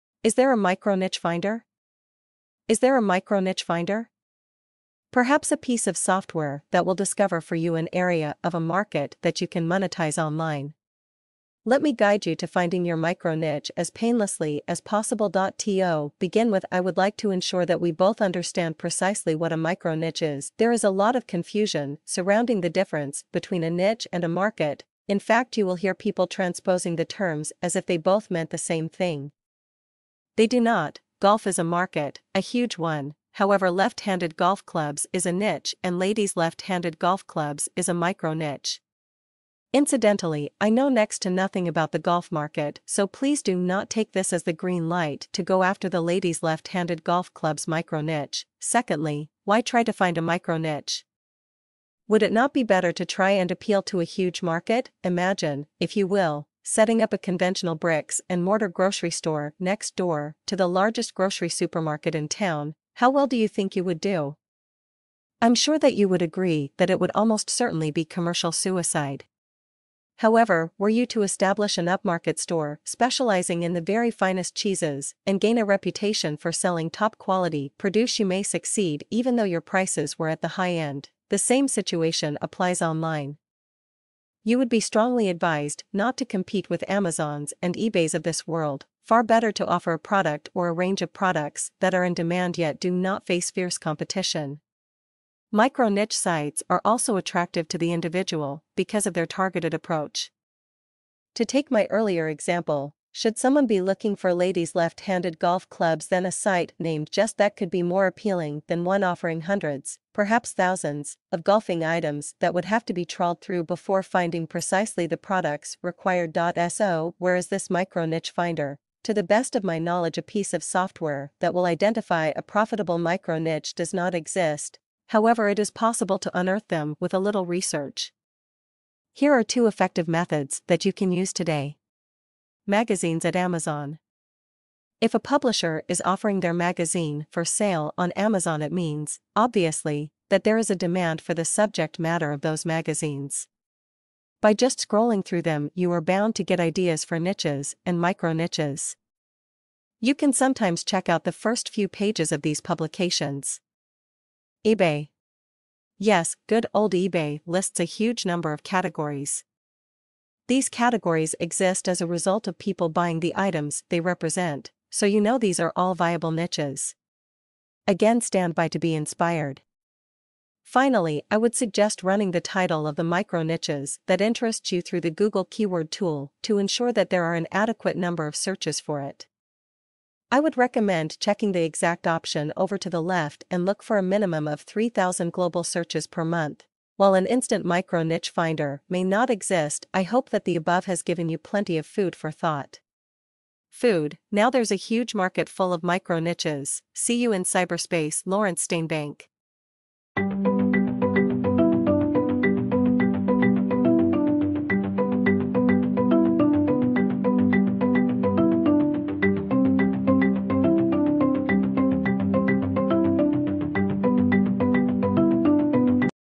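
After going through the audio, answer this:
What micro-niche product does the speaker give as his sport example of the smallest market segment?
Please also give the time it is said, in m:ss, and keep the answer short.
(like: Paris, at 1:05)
Ladies left-handed golf clubs, at 0:35.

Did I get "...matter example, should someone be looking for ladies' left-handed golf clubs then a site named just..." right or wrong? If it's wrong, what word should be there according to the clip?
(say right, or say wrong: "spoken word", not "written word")
wrong: "earlier", not "matter".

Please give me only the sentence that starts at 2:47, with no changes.
Again, stand by to be inspired.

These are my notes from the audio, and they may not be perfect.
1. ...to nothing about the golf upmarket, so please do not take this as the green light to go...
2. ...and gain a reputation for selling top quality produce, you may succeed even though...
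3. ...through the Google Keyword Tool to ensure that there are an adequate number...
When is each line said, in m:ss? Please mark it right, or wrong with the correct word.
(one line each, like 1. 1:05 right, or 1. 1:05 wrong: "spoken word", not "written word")
1. 0:41 wrong: "market", not "upmarket"
2. 1:15 right
3. 2:54 right.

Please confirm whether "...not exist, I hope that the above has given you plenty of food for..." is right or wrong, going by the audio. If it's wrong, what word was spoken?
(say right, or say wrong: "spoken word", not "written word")
right.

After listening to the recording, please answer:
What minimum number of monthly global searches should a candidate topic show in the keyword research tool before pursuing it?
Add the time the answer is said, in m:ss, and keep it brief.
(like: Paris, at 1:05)
3,000, at 3:04.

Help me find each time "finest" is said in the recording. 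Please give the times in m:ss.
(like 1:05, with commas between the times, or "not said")
1:14.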